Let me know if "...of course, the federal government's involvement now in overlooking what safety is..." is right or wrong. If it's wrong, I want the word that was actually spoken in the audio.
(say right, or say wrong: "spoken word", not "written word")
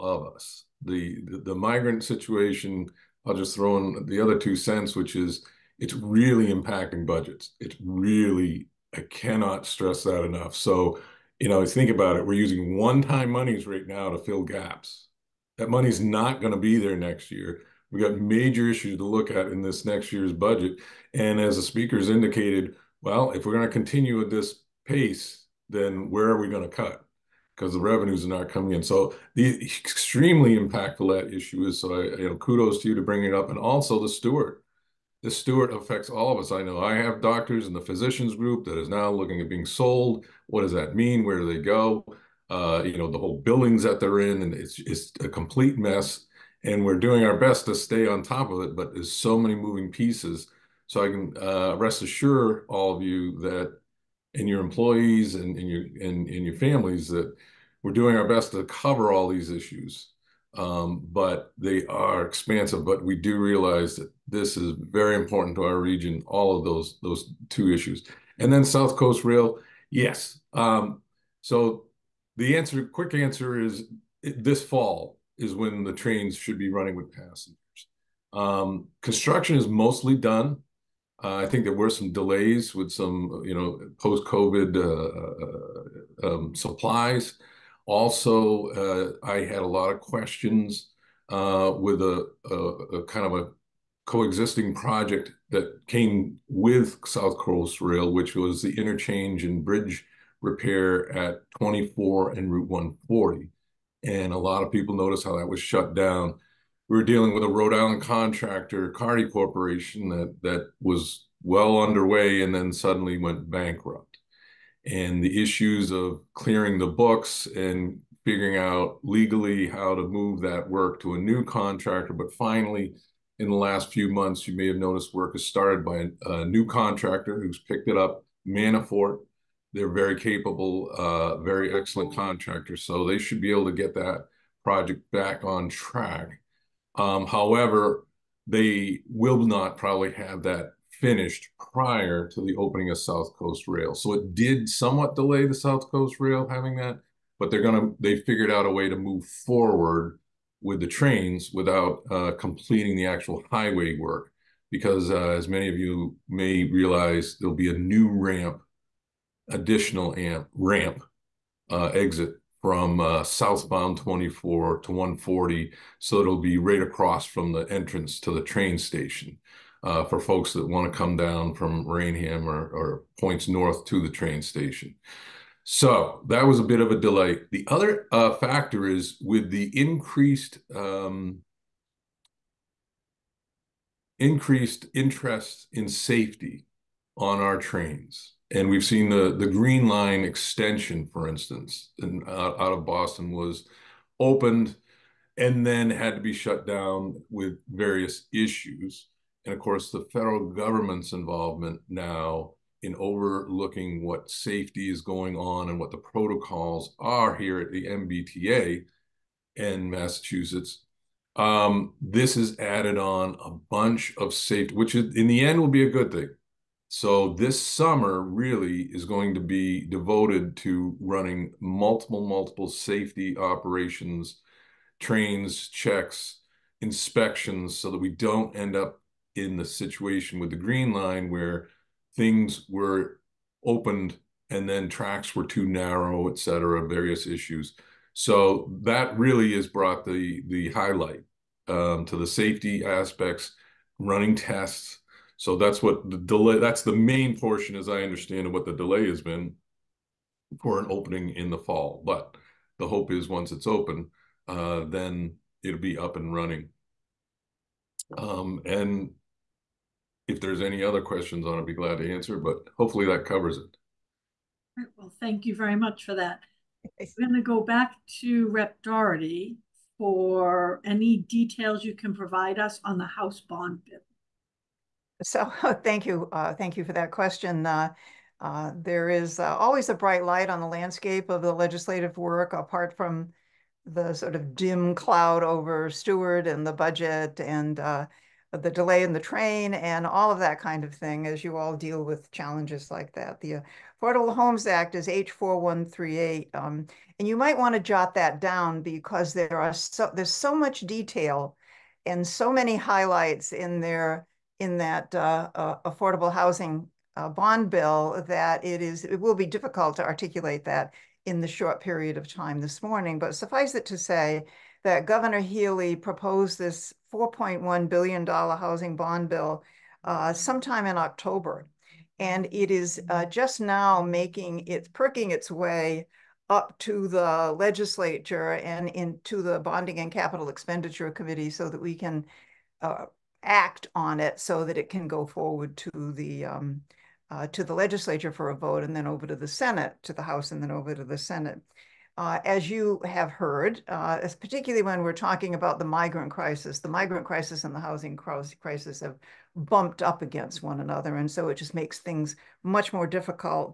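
right.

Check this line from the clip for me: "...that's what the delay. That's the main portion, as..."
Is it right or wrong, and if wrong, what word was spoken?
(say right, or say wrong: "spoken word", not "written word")
right.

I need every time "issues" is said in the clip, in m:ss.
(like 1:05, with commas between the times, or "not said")
0:18, 0:31, 0:59, 1:07, 1:55, 3:18, 3:57.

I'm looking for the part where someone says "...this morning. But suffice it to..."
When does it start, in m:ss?
5:12.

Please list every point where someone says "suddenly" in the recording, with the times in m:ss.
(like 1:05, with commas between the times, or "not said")
1:52.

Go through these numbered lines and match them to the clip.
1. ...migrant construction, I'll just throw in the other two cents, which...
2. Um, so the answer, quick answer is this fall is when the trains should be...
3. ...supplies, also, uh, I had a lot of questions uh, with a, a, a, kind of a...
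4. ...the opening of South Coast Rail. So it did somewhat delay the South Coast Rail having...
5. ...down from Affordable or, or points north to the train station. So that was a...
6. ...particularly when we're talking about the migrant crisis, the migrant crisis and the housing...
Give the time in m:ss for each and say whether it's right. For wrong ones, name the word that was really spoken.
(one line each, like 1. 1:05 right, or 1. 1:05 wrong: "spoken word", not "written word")
1. 0:01 wrong: "situation", not "construction"
2. 1:10 right
3. 1:26 right
4. 2:22 right
5. 2:51 wrong: "Raynham", not "Affordable"
6. 5:44 right.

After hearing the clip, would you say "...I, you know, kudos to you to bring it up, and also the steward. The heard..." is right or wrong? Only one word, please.
wrong.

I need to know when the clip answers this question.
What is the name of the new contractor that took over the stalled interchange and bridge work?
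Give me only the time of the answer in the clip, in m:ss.
2:08.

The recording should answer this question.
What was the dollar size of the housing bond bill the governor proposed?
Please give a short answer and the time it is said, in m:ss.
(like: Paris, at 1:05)
$4.1 billion, at 5:17.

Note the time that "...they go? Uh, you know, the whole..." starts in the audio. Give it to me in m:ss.
0:41.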